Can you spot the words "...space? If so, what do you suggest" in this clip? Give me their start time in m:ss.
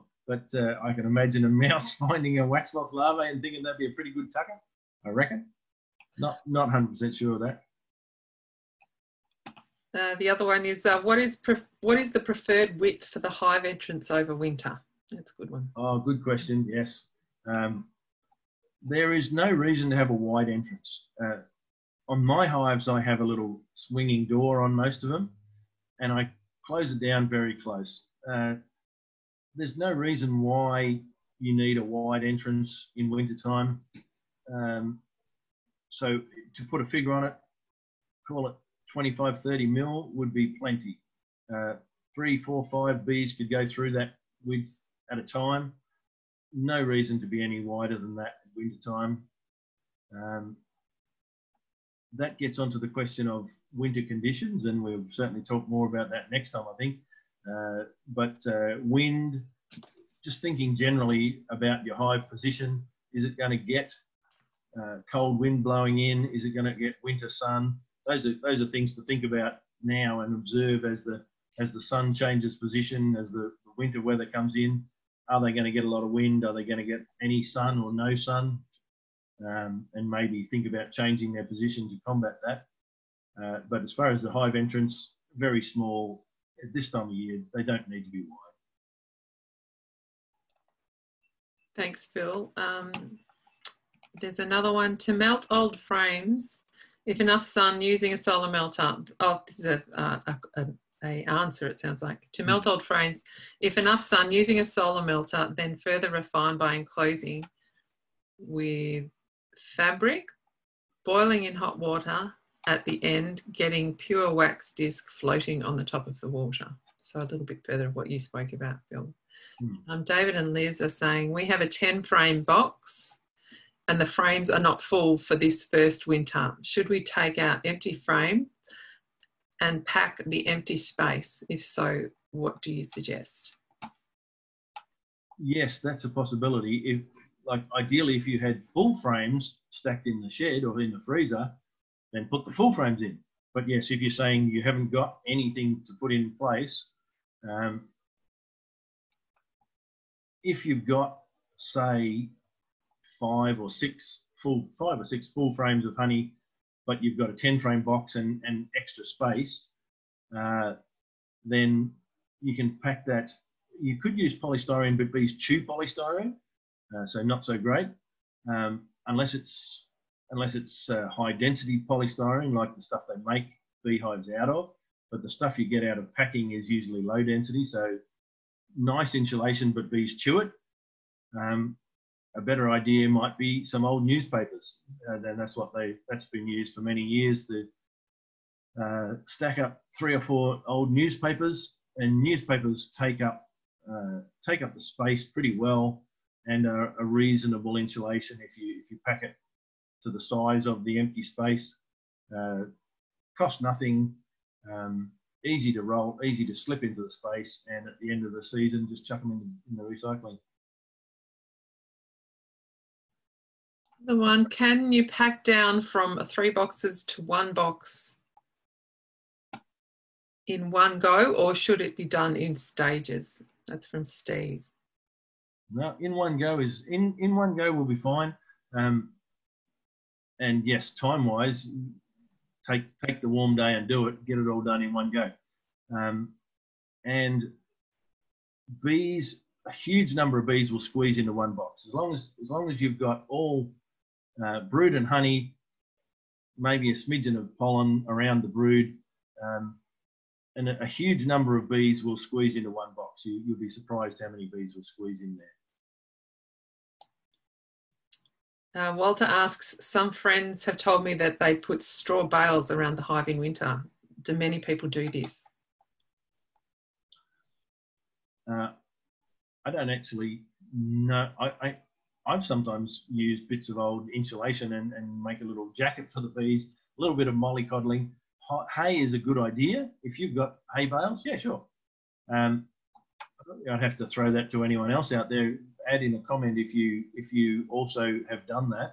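2:10.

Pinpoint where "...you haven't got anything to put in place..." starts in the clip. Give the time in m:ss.
2:24.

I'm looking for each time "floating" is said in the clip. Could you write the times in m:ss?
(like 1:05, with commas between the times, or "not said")
1:55.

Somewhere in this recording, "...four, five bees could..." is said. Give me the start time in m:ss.
0:42.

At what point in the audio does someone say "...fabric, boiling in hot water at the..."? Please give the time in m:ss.
1:49.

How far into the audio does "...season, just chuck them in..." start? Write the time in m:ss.
3:28.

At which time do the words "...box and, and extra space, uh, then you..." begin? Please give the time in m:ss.
2:37.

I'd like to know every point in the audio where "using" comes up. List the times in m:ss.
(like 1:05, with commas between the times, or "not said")
1:37, 1:44.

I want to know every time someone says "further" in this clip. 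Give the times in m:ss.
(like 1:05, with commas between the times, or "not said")
1:45, 1:57.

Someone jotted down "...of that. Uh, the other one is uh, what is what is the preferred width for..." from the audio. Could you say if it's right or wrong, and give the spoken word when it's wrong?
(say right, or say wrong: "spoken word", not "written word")
right.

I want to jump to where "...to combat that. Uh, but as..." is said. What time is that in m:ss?
1:21.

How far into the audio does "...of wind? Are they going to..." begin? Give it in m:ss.
1:16.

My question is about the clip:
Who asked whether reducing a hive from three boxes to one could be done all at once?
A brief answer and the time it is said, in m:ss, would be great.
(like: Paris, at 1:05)
Steve, at 3:44.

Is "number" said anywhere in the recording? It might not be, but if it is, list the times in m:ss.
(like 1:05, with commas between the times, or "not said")
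4:00, 4:11.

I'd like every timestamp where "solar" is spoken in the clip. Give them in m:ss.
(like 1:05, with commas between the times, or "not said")
1:38, 1:44.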